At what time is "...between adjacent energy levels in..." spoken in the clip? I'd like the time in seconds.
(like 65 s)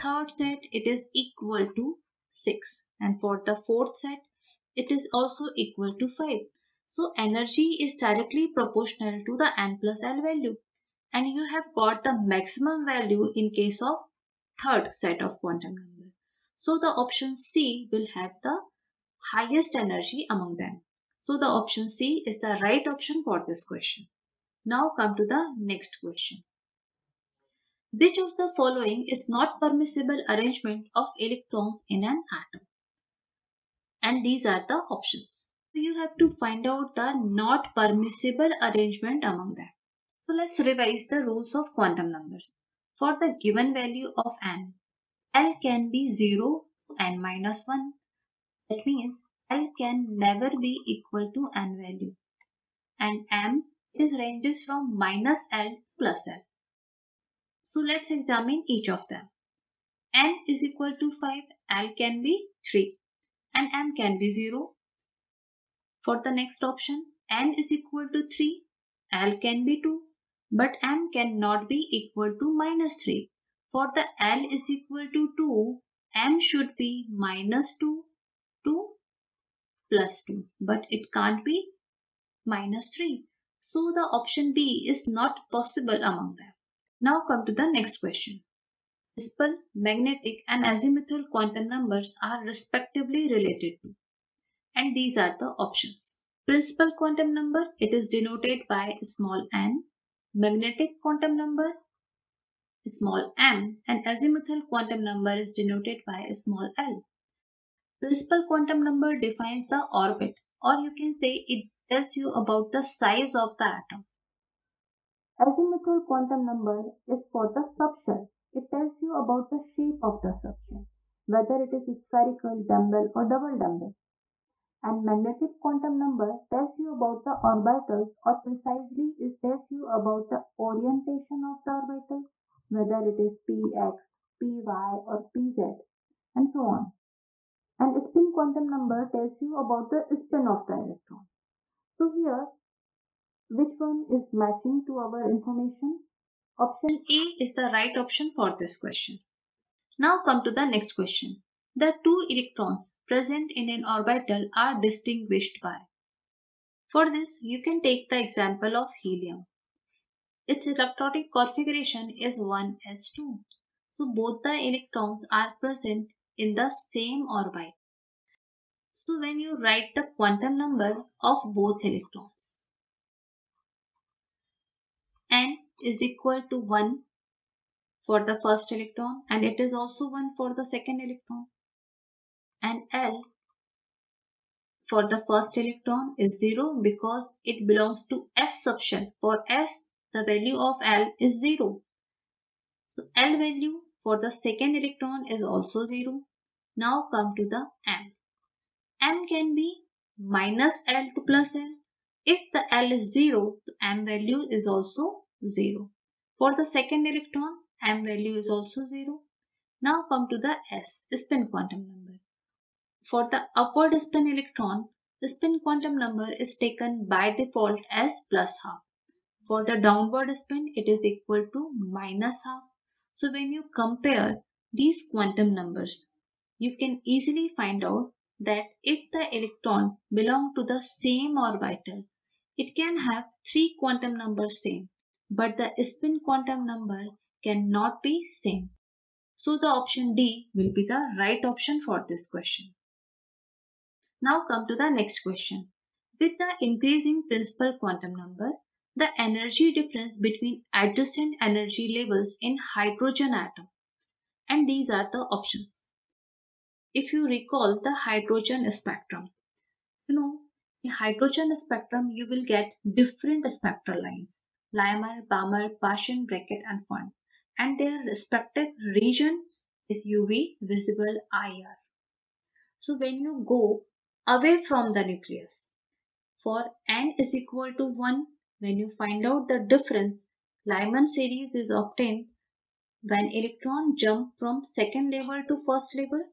250 s.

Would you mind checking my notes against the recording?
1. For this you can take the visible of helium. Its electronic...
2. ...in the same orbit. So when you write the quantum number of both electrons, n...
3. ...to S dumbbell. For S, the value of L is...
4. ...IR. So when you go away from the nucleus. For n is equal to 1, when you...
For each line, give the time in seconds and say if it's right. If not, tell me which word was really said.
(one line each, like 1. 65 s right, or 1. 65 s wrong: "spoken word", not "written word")
1. 156 s wrong: "example", not "visible"
2. 166 s right
3. 188 s wrong: "subshell", not "dumbbell"
4. 271 s right.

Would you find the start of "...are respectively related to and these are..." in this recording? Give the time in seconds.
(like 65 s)
92 s.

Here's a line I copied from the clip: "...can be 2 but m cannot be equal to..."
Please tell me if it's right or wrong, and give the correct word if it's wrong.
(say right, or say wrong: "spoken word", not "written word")
right.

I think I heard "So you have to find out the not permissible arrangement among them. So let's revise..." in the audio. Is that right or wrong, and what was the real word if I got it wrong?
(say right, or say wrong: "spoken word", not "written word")
right.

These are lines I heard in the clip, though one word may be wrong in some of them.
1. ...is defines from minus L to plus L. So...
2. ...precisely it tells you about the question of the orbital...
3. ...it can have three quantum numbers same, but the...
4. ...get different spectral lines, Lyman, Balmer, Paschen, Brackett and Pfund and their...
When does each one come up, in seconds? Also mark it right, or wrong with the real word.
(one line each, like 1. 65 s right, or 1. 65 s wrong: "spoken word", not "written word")
1. 53 s wrong: "ranges", not "defines"
2. 128 s wrong: "orientation", not "question"
3. 232 s right
4. 262 s right.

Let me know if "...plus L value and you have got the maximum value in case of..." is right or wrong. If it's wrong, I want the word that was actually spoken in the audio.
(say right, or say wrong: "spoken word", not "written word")
right.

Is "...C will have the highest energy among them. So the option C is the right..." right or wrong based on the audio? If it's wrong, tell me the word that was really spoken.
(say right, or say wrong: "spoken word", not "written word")
right.